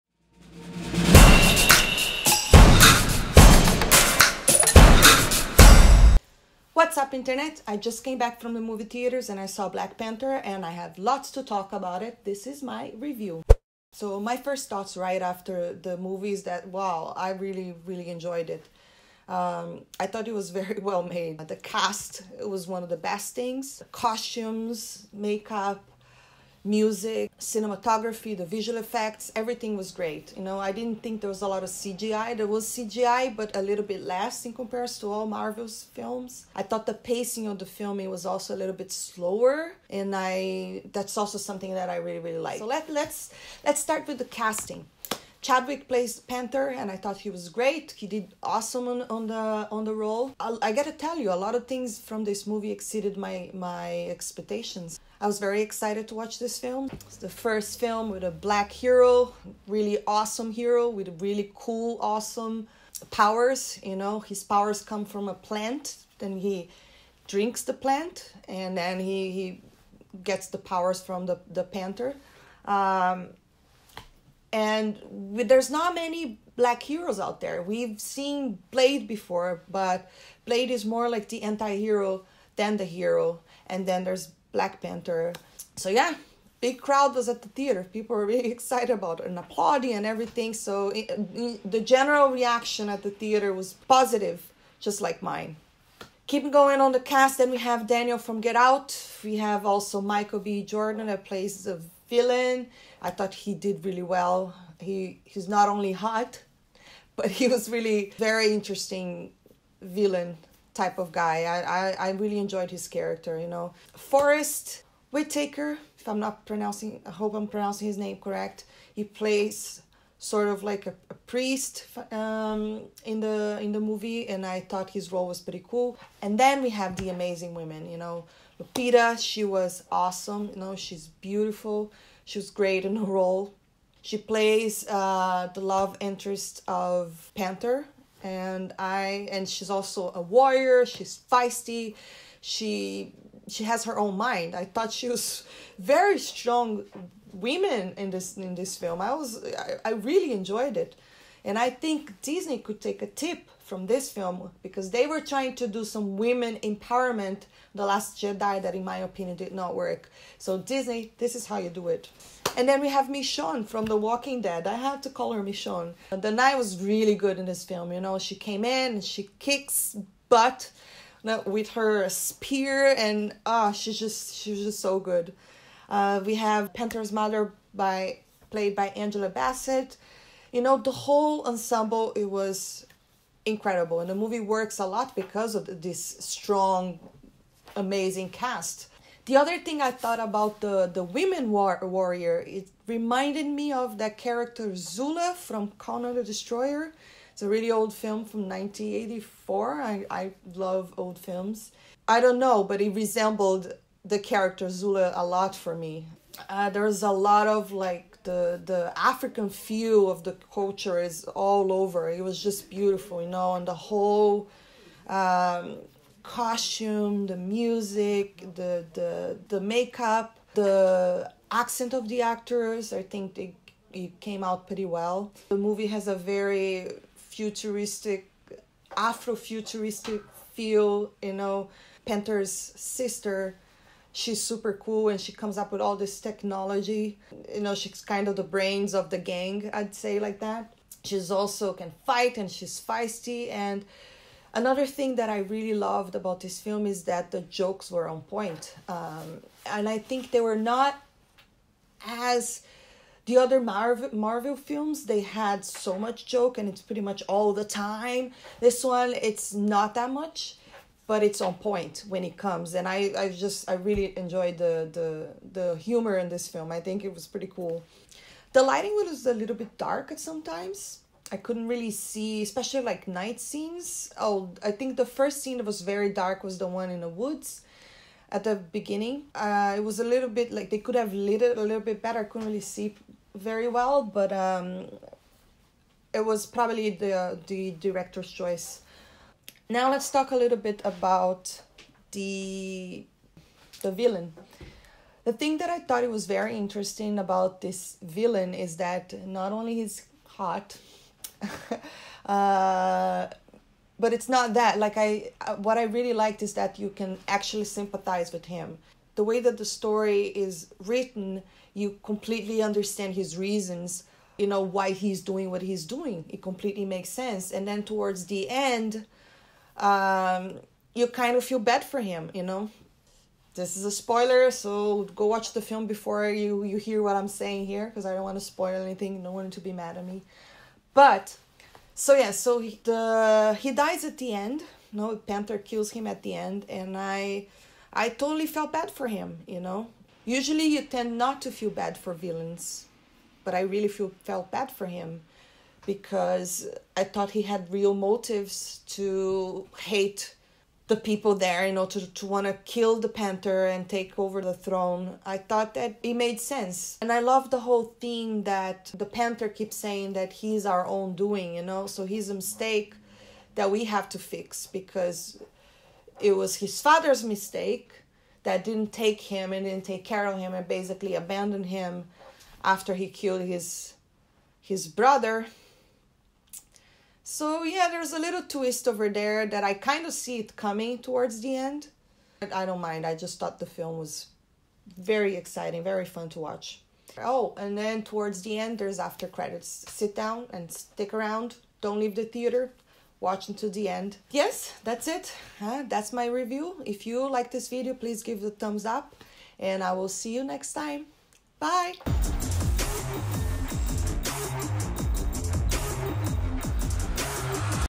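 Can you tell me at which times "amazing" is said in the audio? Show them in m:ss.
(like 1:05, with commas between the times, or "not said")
2:07, 3:07.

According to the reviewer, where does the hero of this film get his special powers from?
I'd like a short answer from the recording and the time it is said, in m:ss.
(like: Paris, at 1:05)
A plant, at 1:05.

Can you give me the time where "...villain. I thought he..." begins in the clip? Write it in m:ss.
1:42.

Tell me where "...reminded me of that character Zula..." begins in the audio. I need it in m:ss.
3:12.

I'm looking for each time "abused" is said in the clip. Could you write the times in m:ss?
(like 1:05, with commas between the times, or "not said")
not said.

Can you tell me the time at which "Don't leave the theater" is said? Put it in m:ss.
6:31.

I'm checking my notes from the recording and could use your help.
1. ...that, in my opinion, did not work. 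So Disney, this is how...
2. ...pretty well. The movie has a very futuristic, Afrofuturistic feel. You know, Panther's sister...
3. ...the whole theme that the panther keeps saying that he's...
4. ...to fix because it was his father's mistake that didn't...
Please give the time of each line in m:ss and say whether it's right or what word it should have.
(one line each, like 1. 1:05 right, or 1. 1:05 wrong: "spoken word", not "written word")
1. 2:38 right
2. 3:44 right
3. 5:57 right
4. 6:04 right.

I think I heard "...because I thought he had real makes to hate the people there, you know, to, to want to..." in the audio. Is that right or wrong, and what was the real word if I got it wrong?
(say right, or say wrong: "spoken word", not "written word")
wrong: "motives", not "makes".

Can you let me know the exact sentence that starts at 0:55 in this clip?
I was very excited to watch this film.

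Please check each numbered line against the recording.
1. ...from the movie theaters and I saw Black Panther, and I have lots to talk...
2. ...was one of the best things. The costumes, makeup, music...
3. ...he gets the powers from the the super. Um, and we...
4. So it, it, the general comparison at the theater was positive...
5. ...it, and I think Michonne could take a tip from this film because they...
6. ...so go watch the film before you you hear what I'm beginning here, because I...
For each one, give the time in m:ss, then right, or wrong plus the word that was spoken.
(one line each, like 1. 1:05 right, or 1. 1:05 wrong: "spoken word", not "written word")
1. 0:08 right
2. 0:22 right
3. 1:09 wrong: "panther", not "super"
4. 1:30 wrong: "reaction", not "comparison"
5. 2:30 wrong: "Disney", not "Michonne"
6. 5:24 wrong: "saying", not "beginning".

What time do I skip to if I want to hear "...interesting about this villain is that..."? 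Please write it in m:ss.
4:56.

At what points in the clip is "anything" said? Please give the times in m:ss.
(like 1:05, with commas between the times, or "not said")
5:28.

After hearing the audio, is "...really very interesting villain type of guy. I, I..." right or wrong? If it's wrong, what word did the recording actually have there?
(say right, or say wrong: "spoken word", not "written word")
right.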